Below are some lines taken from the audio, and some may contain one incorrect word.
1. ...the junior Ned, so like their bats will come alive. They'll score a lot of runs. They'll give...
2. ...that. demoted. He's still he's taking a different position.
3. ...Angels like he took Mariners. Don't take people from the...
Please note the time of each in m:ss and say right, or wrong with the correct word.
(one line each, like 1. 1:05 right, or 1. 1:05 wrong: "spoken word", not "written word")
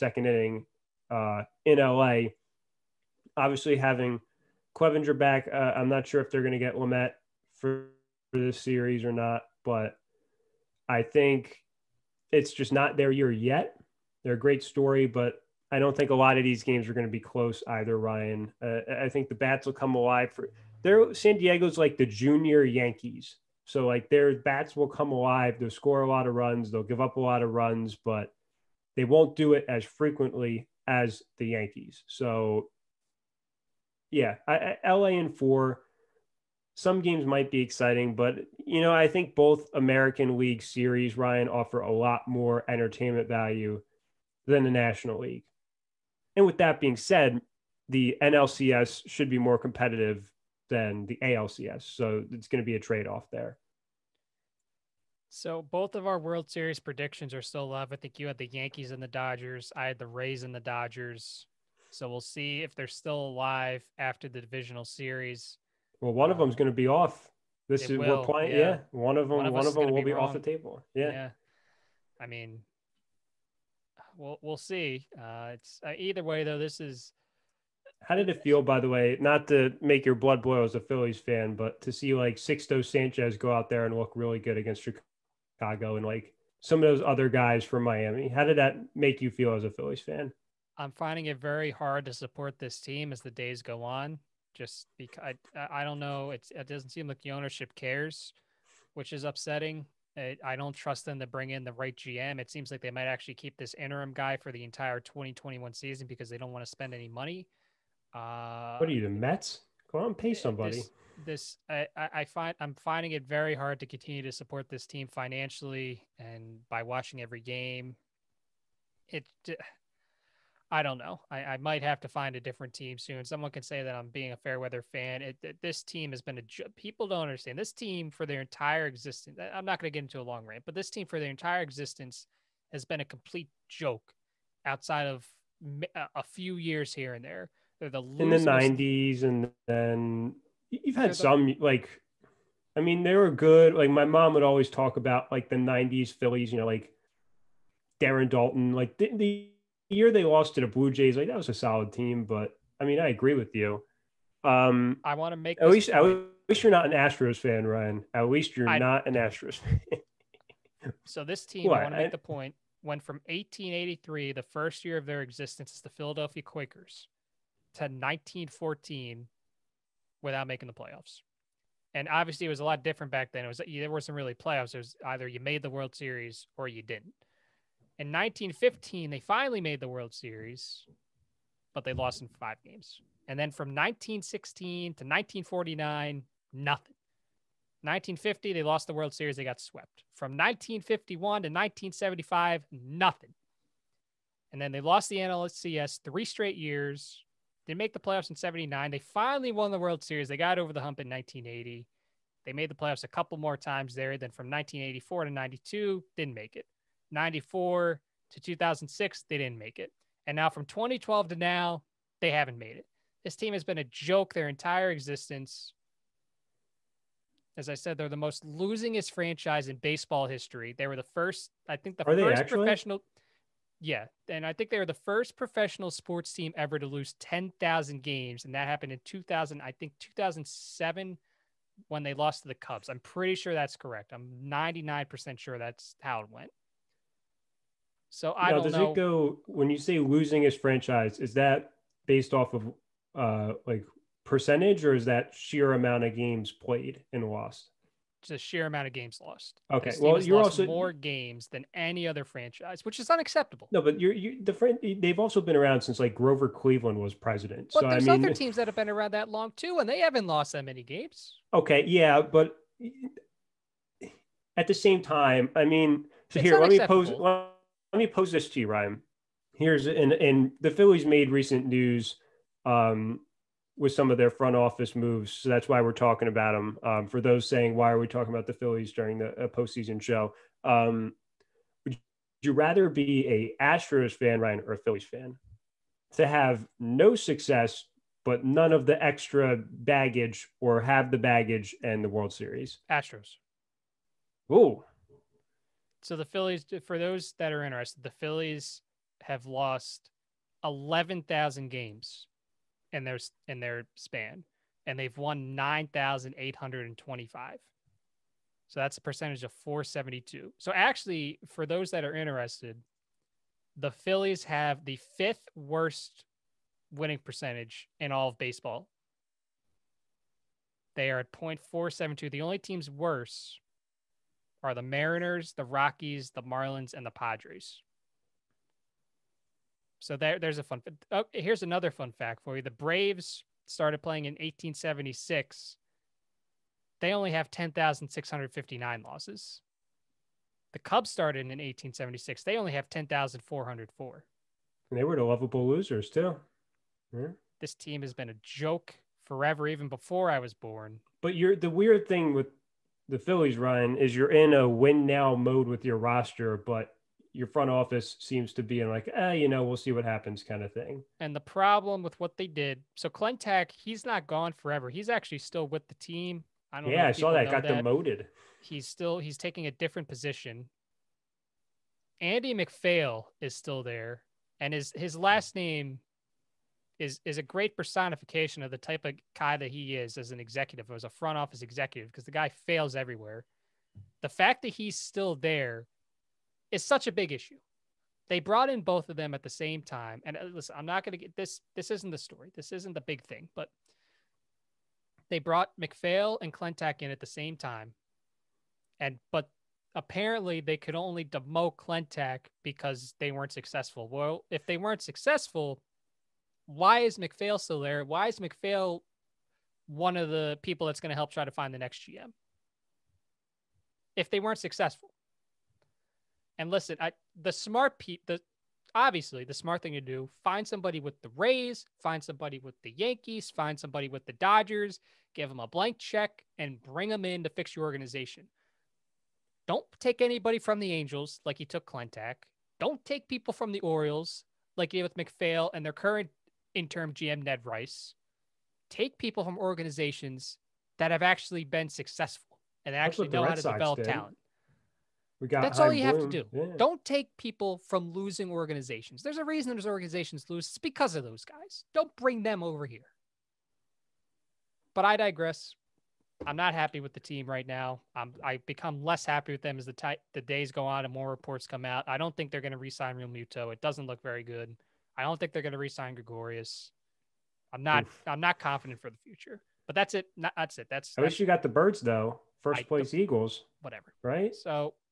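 1. 0:21 wrong: "Yankees", not "Ned"
2. 6:07 right
3. 7:10 wrong: "Klentak", not "Mariners".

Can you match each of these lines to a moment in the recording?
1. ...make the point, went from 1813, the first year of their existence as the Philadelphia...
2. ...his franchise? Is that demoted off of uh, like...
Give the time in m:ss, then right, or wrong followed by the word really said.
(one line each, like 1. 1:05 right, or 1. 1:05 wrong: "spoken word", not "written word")
1. 2:42 wrong: "1883", not "1813"
2. 4:00 wrong: "based", not "demoted".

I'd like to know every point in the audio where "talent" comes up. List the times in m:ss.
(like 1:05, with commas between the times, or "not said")
7:24.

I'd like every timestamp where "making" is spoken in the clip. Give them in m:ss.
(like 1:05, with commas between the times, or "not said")
2:50.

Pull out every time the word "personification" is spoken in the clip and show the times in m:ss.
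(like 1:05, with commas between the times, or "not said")
6:17.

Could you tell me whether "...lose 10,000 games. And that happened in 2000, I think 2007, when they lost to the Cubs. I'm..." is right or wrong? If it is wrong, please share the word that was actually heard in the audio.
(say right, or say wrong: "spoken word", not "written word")
right.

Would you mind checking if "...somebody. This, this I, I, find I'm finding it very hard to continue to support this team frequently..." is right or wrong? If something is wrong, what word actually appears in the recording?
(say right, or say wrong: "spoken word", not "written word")
wrong: "financially", not "frequently".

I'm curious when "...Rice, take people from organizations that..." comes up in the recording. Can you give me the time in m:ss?
7:17.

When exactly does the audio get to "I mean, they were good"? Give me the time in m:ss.
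2:22.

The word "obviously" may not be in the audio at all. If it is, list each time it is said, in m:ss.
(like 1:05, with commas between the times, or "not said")
0:03, 2:52, 6:58.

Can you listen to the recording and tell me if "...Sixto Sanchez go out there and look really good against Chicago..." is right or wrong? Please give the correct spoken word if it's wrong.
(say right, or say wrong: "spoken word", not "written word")
right.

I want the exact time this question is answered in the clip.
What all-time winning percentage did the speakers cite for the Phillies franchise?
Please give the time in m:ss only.
5:21.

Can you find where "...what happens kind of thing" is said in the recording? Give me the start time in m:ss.
5:59.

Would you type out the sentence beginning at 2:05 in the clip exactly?
It, it, this team has been a people don't understand this team for their entire existence.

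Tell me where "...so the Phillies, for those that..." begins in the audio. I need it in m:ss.
4:56.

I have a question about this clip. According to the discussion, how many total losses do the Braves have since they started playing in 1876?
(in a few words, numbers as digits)
10,659.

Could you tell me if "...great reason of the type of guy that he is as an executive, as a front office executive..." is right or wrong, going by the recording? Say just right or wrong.
wrong.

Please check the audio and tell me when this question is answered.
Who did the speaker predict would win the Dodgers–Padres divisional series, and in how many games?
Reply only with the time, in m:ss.
0:34.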